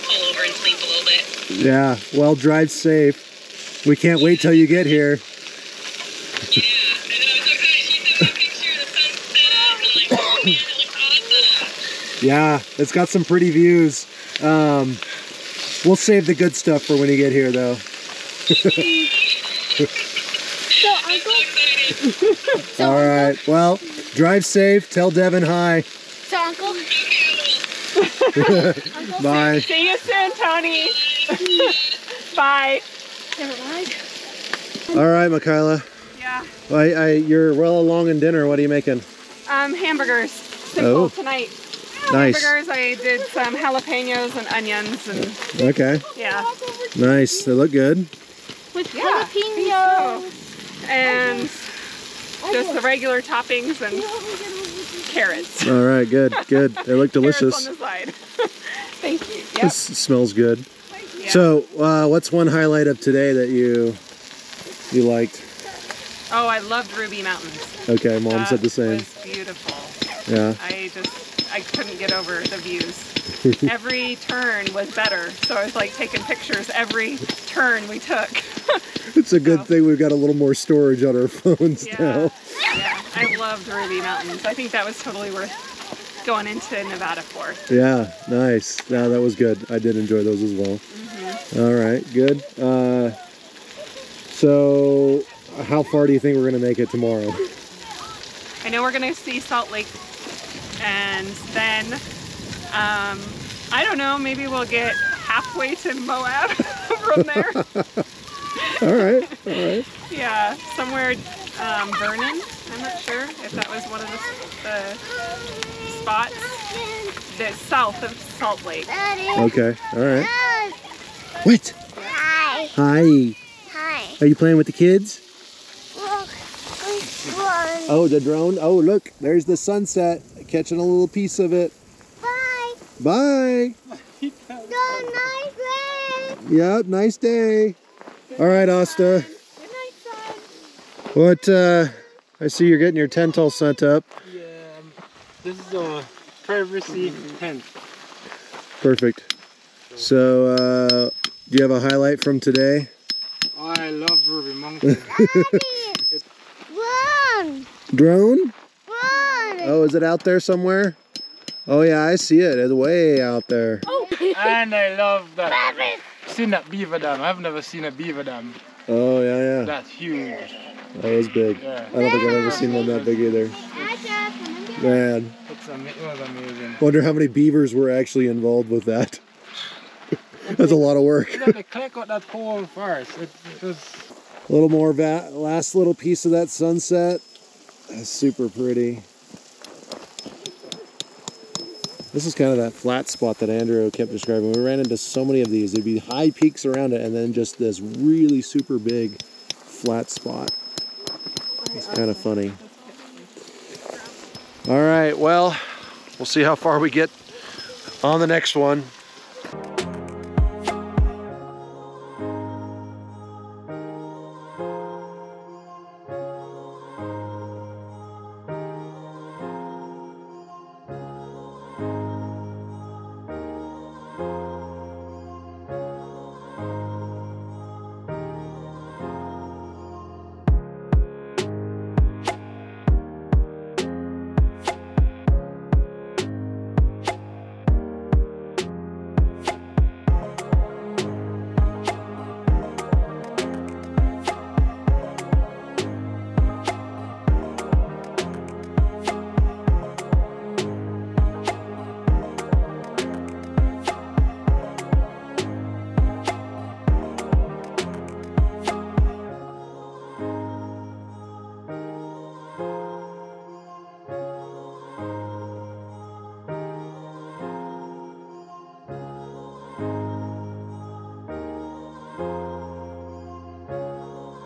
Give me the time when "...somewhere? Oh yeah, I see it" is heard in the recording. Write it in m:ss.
2:40.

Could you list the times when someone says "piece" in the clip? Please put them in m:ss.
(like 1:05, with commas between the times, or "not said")
2:11, 3:05.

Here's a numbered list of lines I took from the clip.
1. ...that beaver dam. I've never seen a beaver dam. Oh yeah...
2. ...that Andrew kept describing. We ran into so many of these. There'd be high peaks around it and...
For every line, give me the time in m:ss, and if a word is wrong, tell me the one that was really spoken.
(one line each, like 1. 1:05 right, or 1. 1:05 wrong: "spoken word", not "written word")
1. 2:46 right
2. 3:13 right.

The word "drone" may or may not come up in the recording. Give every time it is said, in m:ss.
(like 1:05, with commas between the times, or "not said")
2:08, 2:37.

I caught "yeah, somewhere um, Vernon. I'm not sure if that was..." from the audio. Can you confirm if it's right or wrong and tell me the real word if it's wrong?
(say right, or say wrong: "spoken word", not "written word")
right.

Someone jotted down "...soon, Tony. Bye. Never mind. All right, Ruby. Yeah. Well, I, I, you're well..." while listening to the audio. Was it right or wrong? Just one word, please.
wrong.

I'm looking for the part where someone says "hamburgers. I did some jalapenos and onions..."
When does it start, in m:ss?
0:42.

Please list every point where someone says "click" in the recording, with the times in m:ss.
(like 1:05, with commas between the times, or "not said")
3:01.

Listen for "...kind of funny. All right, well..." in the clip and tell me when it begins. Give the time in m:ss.
3:21.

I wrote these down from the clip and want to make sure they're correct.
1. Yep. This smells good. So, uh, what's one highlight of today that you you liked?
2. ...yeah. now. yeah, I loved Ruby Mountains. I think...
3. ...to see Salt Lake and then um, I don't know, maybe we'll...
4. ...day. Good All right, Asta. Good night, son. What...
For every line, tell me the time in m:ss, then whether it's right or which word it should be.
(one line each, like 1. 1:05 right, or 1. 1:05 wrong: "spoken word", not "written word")
1. 0:59 right
2. 1:21 right
3. 1:39 right
4. 2:17 right.